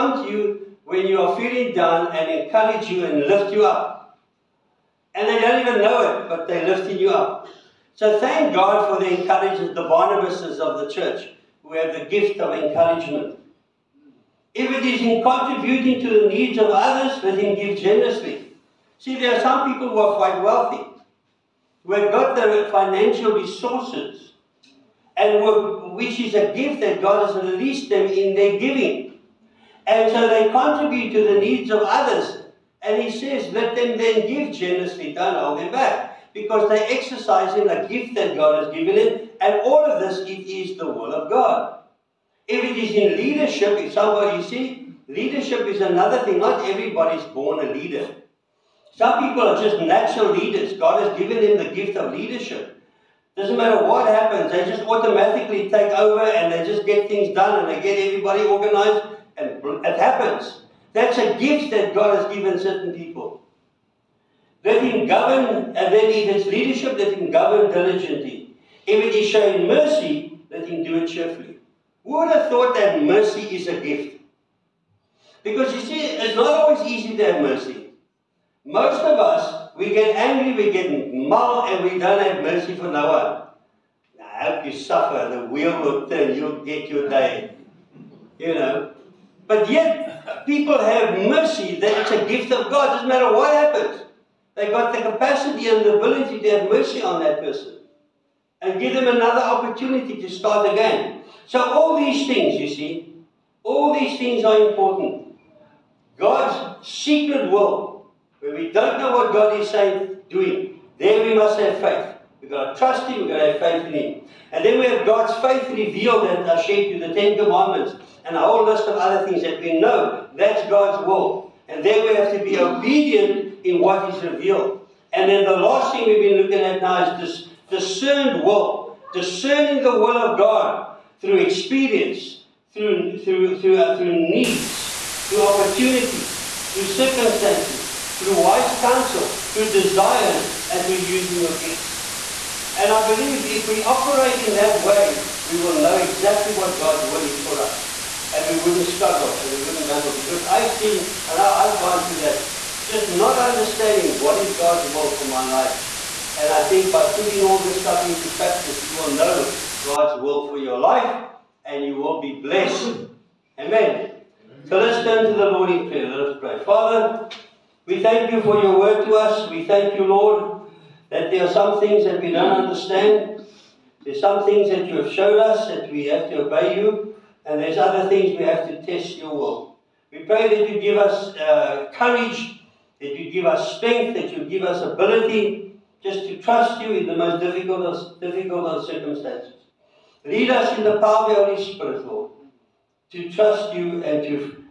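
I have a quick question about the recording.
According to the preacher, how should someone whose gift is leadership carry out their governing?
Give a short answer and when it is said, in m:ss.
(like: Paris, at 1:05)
Diligently, at 1:07.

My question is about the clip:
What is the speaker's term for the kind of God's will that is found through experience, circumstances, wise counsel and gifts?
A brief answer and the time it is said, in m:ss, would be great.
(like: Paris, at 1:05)
Discerned will, at 2:07.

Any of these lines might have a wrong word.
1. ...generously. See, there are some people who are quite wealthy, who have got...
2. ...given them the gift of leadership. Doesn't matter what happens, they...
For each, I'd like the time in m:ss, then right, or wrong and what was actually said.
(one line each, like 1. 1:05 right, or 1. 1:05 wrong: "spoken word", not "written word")
1. 0:17 right
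2. 0:51 right.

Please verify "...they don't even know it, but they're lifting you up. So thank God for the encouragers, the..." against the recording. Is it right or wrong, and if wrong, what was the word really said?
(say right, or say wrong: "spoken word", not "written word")
right.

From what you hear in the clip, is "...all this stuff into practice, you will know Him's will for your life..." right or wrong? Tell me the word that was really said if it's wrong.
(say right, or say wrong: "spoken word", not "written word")
wrong: "God", not "Him".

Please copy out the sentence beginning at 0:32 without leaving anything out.
And he says, let them then give generously, don't hold them back.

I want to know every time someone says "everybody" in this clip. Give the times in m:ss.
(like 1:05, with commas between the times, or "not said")
0:46, 0:58.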